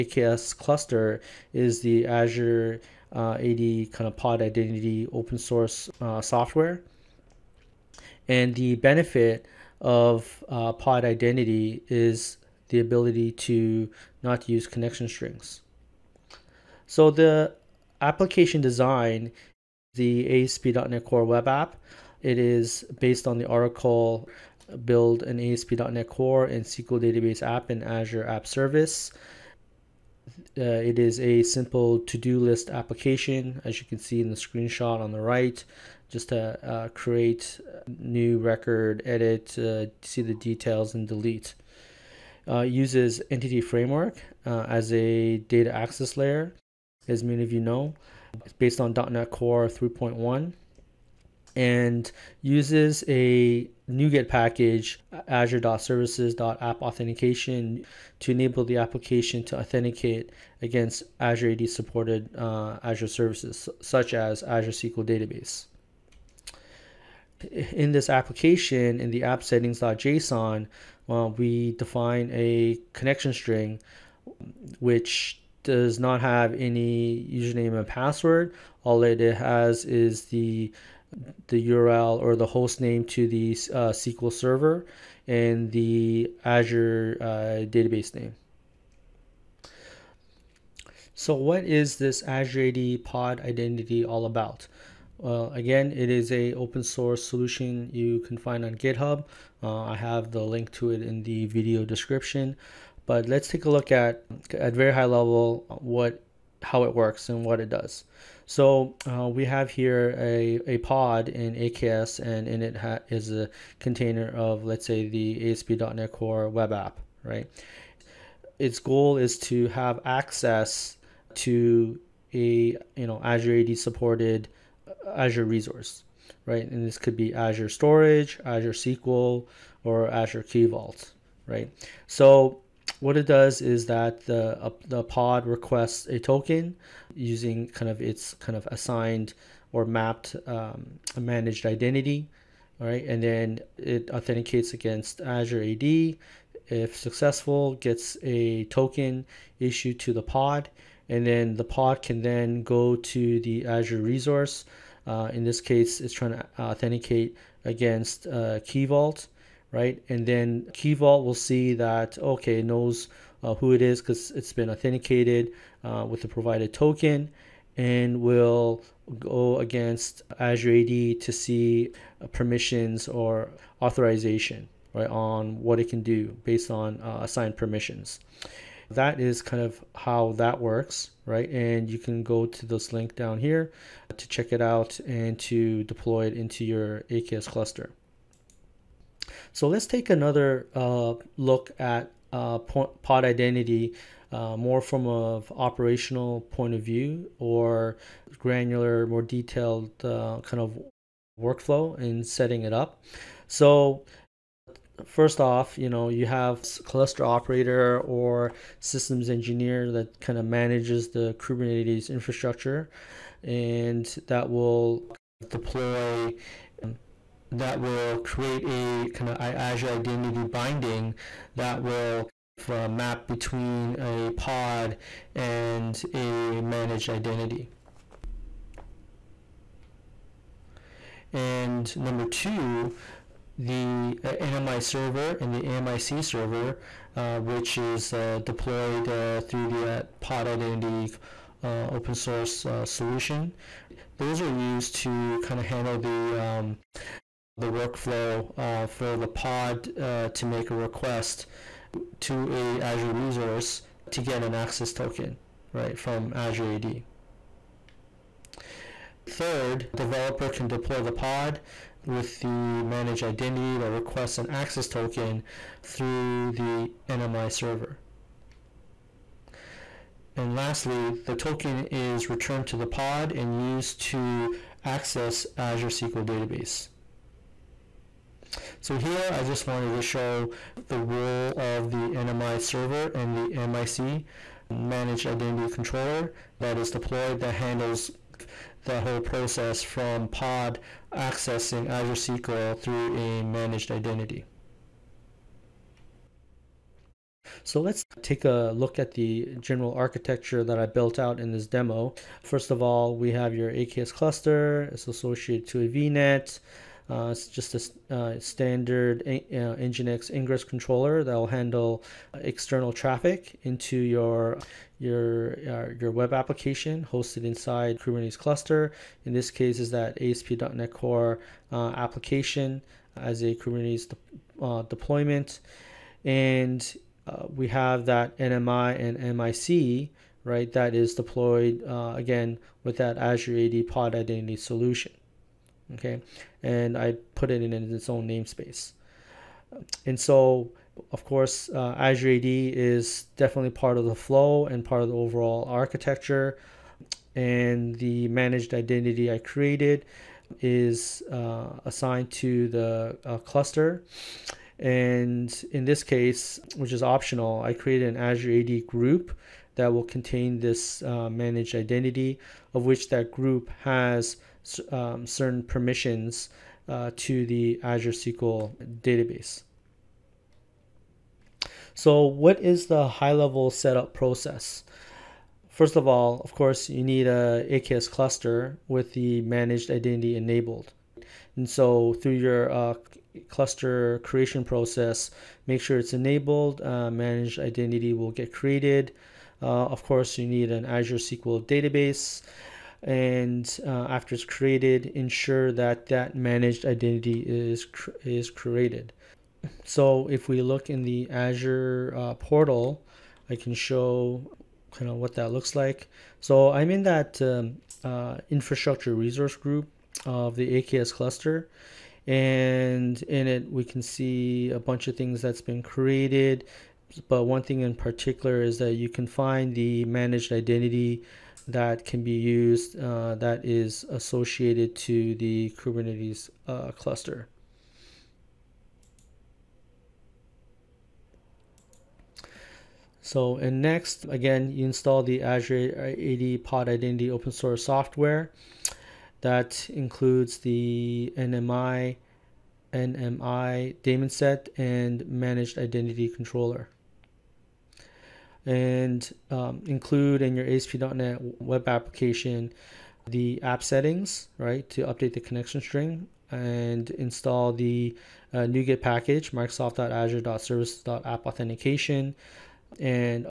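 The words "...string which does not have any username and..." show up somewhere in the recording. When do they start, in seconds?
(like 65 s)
73 s.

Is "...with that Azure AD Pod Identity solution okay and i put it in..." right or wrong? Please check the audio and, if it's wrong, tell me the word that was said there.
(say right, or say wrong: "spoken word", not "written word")
right.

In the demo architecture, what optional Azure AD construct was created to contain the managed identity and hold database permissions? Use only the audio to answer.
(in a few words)
Azure AD group.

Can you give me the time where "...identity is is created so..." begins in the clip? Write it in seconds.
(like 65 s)
396 s.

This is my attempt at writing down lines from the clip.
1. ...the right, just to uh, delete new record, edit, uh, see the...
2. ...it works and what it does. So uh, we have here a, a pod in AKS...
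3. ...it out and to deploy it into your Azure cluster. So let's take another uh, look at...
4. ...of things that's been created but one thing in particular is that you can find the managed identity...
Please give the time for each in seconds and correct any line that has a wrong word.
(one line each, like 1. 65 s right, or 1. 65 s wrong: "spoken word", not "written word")
1. 35 s wrong: "create", not "delete"
2. 106 s right
3. 184 s wrong: "AKS", not "Azure"
4. 415 s right.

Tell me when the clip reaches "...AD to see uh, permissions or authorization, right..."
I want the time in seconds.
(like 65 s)
170 s.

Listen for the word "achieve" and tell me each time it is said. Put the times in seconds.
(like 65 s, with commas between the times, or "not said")
not said.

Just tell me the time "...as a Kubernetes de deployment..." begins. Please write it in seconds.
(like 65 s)
323 s.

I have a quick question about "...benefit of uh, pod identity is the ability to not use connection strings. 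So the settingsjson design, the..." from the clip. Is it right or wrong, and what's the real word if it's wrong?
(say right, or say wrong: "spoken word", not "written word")
wrong: "application", not "settingsjson".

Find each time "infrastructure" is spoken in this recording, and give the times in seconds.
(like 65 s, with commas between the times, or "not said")
212 s, 408 s.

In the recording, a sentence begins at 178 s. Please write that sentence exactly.
That is kind of how that works, right?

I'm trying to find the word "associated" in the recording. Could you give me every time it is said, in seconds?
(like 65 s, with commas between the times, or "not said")
305 s, 424 s.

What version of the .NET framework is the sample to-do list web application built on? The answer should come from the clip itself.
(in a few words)
.NET Core 3.1.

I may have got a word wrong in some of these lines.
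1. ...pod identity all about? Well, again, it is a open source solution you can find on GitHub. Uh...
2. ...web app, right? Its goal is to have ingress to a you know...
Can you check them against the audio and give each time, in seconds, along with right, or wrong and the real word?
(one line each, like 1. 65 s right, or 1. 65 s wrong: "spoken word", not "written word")
1. 93 s right
2. 116 s wrong: "access", not "ingress".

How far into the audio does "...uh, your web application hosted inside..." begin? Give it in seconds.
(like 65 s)
315 s.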